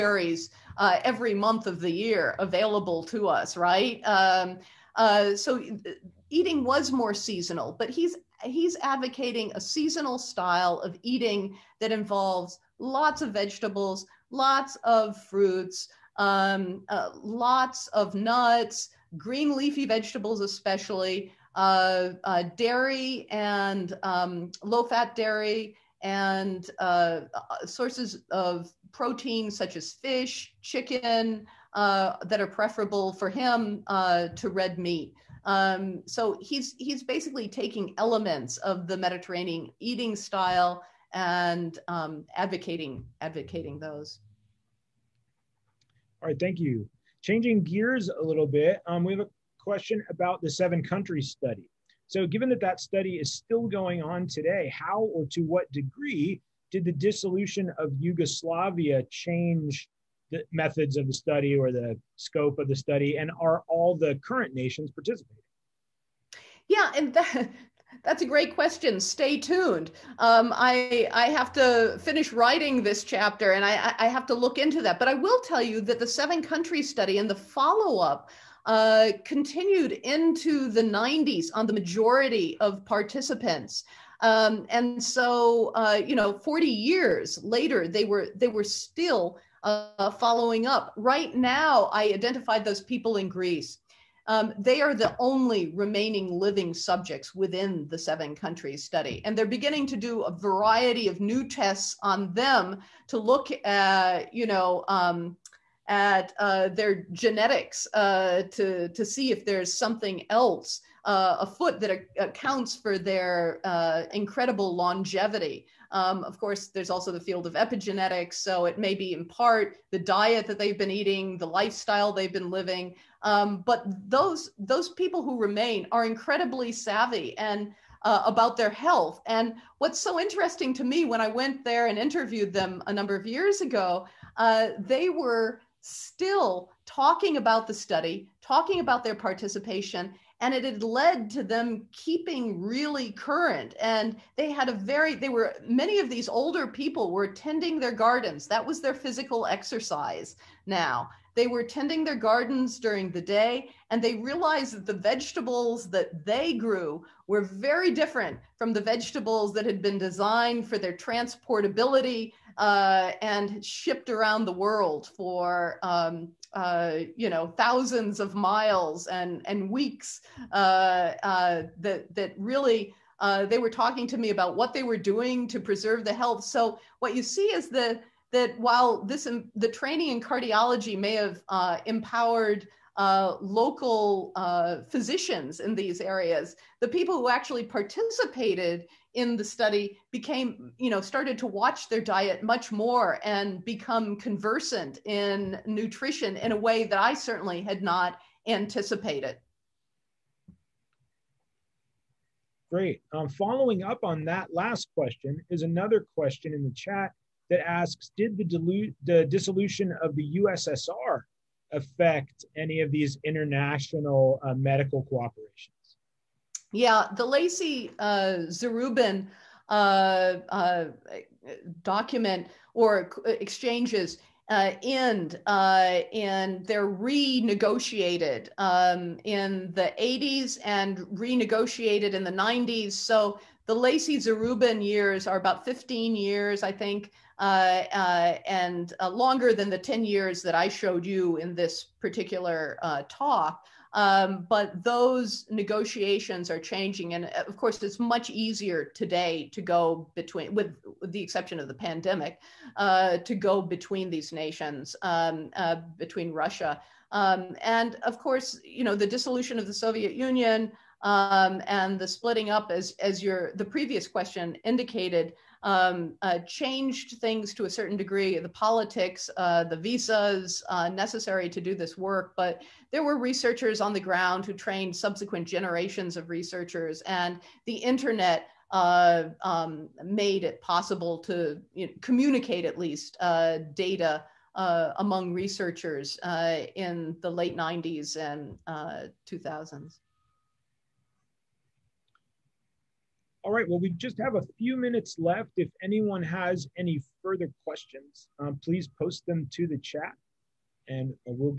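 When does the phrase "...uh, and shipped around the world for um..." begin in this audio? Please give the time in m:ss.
2:42.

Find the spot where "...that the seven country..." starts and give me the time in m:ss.
1:15.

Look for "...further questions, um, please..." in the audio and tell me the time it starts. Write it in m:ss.
4:57.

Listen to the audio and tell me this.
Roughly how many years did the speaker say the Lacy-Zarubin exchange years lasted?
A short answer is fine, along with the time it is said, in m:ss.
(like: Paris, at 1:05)
15 years, at 3:55.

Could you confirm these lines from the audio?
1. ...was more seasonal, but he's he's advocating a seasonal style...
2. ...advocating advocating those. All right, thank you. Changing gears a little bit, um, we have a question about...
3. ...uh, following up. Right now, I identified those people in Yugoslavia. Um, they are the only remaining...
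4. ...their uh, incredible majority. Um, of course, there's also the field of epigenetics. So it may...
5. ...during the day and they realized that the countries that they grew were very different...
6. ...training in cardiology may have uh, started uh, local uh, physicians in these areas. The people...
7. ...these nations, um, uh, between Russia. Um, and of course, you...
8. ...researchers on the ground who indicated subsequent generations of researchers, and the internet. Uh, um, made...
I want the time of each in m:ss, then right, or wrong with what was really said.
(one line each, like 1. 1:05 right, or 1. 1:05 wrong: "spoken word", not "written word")
1. 0:06 right
2. 0:42 right
3. 1:29 wrong: "Greece", not "Yugoslavia"
4. 1:52 wrong: "longevity", not "majority"
5. 2:32 wrong: "vegetables", not "countries"
6. 2:59 wrong: "empowered", not "started"
7. 4:14 right
8. 4:33 wrong: "trained", not "indicated".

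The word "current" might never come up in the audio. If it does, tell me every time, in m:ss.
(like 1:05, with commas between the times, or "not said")
1:04, 2:23.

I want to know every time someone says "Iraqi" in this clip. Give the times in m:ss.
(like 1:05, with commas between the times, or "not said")
not said.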